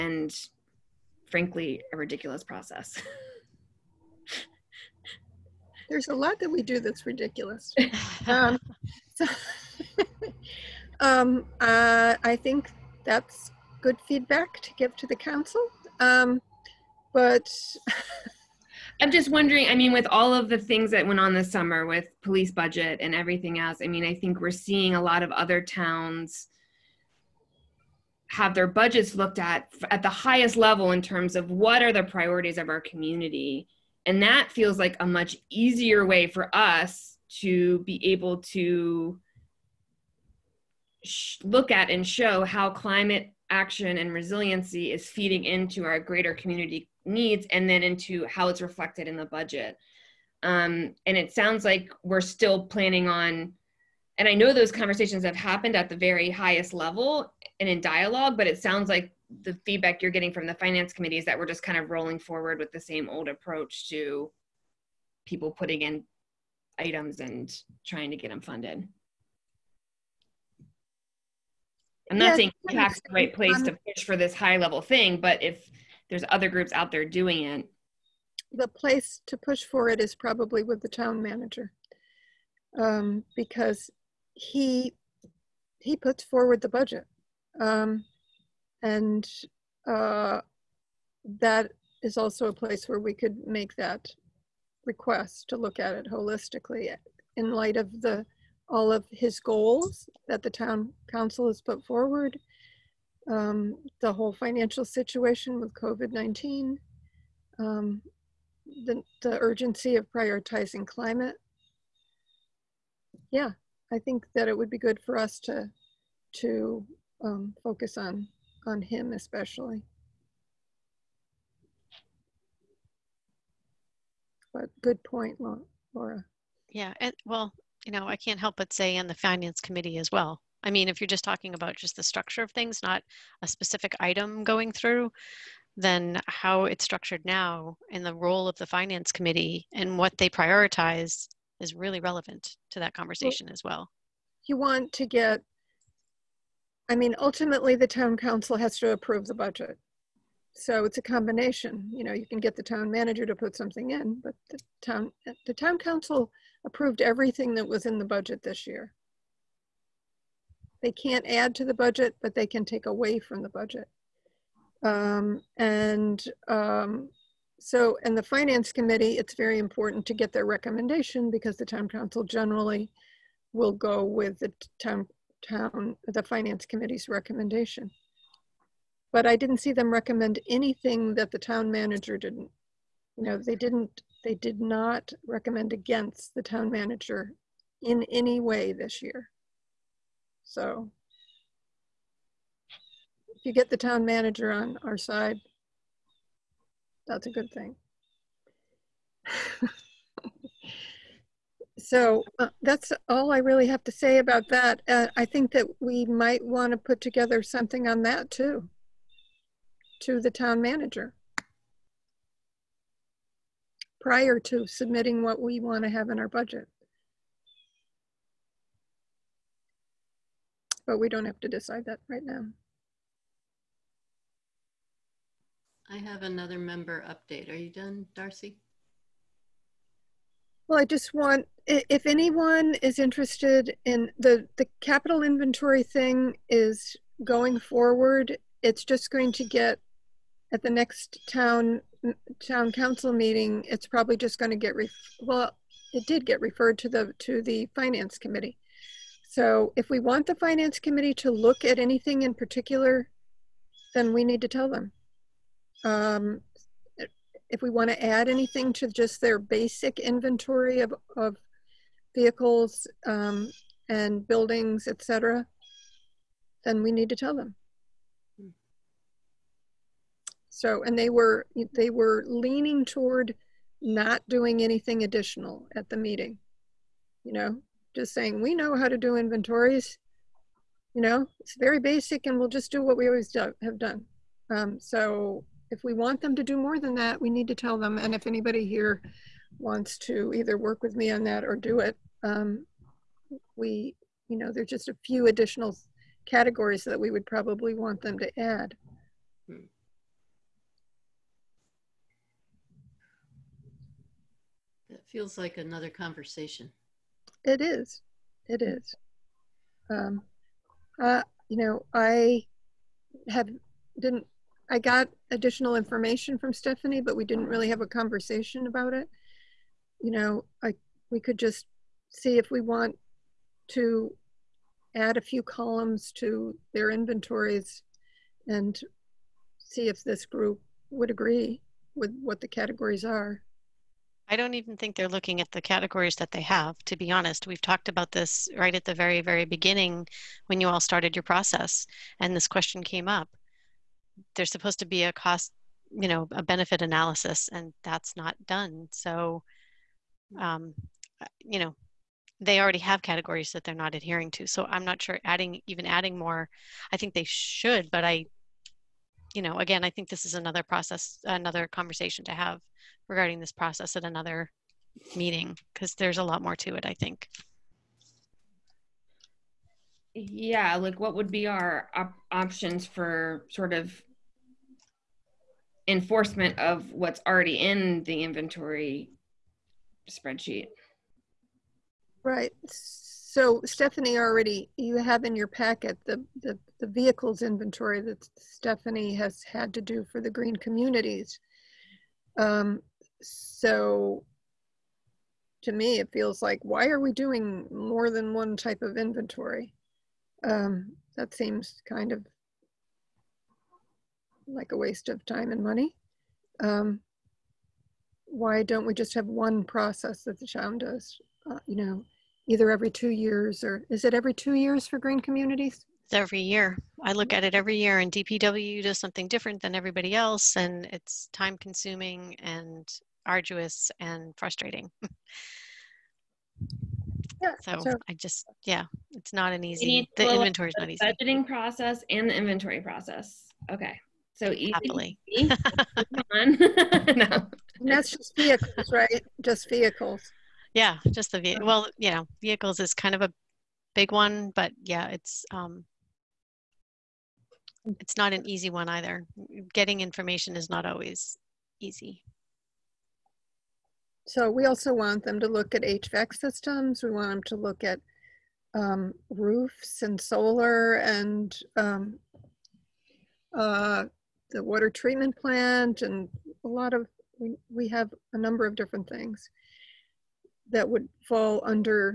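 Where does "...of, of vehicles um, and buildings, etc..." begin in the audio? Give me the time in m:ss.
4:20.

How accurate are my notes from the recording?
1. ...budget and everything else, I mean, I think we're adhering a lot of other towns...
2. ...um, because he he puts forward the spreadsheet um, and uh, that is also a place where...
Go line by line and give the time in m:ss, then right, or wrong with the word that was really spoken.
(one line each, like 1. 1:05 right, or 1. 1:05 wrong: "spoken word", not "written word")
1. 0:22 wrong: "seeing", not "adhering"
2. 1:22 wrong: "budget", not "spreadsheet".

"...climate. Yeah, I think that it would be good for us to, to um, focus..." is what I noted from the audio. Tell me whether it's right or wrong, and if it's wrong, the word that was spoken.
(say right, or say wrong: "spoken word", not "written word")
right.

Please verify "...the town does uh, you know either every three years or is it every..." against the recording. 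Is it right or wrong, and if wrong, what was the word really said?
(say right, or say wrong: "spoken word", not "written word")
wrong: "two", not "three".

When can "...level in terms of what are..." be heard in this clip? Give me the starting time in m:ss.
0:30.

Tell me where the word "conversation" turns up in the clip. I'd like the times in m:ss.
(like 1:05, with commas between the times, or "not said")
0:54, 2:22, 5:05, 5:17, 6:01.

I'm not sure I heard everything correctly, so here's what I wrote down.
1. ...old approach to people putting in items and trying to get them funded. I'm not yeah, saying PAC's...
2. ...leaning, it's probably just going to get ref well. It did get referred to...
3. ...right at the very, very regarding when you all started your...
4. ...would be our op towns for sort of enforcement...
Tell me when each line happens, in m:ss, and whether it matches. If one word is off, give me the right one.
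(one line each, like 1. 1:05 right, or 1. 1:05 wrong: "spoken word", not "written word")
1. 1:03 right
2. 4:03 wrong: "meeting", not "leaning"
3. 5:38 wrong: "beginning", not "regarding"
4. 6:11 wrong: "options", not "towns".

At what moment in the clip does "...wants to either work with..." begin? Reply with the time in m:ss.
4:49.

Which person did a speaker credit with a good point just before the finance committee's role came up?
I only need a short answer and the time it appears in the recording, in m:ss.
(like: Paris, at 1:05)
Laura, at 2:05.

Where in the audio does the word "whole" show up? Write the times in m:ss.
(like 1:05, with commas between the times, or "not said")
1:44.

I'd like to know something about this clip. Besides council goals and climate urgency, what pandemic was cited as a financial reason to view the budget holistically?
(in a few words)
COVID-19.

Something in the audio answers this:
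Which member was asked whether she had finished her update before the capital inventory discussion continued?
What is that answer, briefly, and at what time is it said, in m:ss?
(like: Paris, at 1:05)
Darcy, at 3:48.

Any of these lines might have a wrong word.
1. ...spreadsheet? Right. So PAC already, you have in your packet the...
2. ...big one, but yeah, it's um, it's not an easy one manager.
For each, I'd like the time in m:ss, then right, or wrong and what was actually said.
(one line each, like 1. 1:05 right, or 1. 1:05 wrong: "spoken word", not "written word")
1. 6:20 wrong: "Stephanie", not "PAC"
2. 7:23 wrong: "either", not "manager".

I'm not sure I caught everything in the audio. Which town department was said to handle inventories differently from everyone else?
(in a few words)
DPW.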